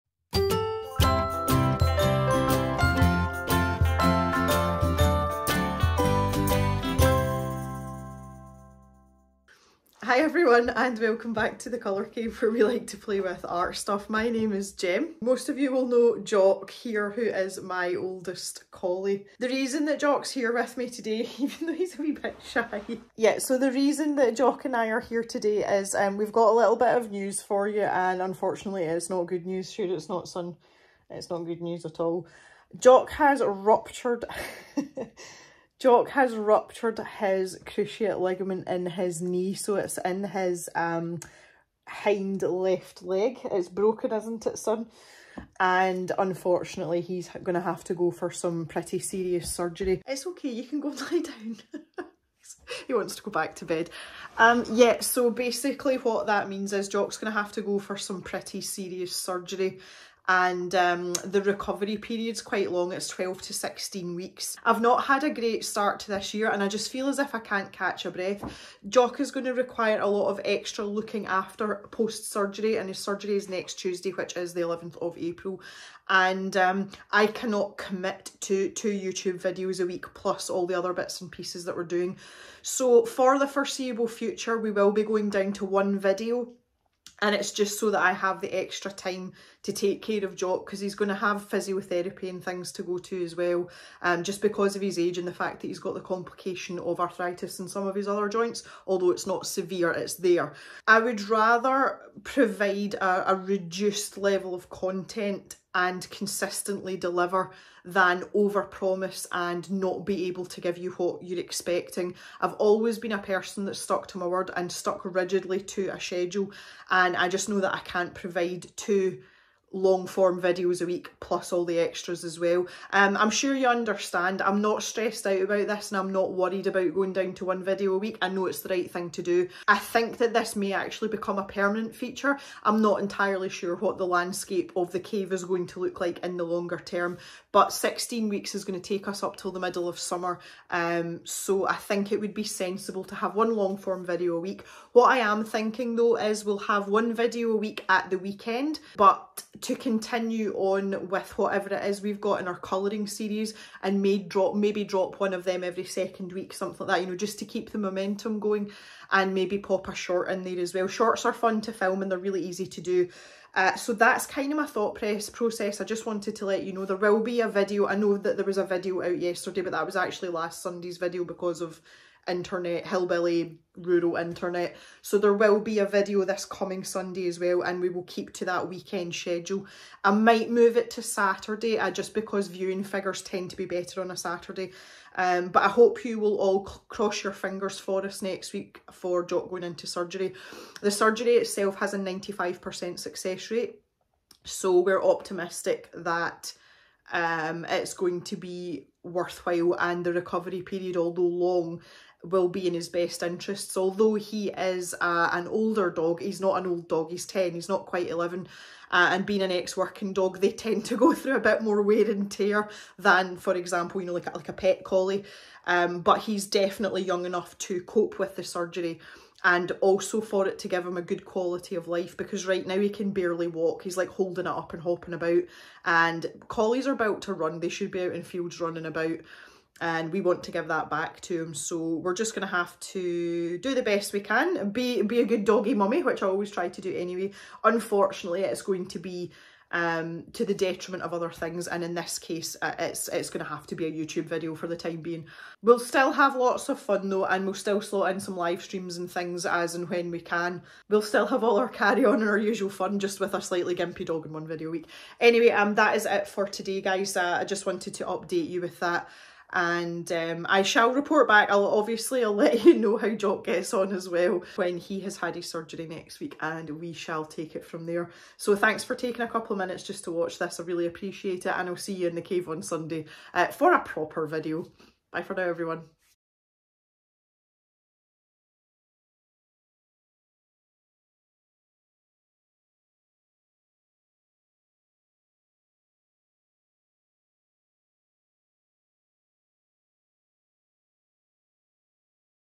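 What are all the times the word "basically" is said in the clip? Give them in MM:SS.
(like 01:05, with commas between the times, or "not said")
00:55.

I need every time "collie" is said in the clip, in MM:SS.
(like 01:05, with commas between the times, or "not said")
00:18, 03:34, 03:46.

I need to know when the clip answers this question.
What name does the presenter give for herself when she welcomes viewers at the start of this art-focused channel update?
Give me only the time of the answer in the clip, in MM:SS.
00:14.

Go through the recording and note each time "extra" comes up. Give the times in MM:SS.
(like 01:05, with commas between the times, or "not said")
01:10, 01:28, 02:01.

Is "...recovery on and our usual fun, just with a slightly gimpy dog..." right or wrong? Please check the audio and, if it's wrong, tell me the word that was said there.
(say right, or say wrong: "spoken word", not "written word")
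wrong: "carry", not "recovery".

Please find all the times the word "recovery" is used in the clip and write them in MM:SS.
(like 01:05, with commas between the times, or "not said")
01:01, 03:20.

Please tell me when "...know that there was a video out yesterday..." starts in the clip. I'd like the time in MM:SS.
02:47.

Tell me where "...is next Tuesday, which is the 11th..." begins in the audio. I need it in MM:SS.
01:13.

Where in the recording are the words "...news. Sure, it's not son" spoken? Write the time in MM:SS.
00:29.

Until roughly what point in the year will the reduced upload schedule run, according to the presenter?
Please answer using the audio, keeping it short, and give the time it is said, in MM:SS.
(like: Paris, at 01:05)
middle of summer, at 02:19.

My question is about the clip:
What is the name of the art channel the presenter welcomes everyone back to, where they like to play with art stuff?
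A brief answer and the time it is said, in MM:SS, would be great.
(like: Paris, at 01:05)
Colour Cave, at 00:11.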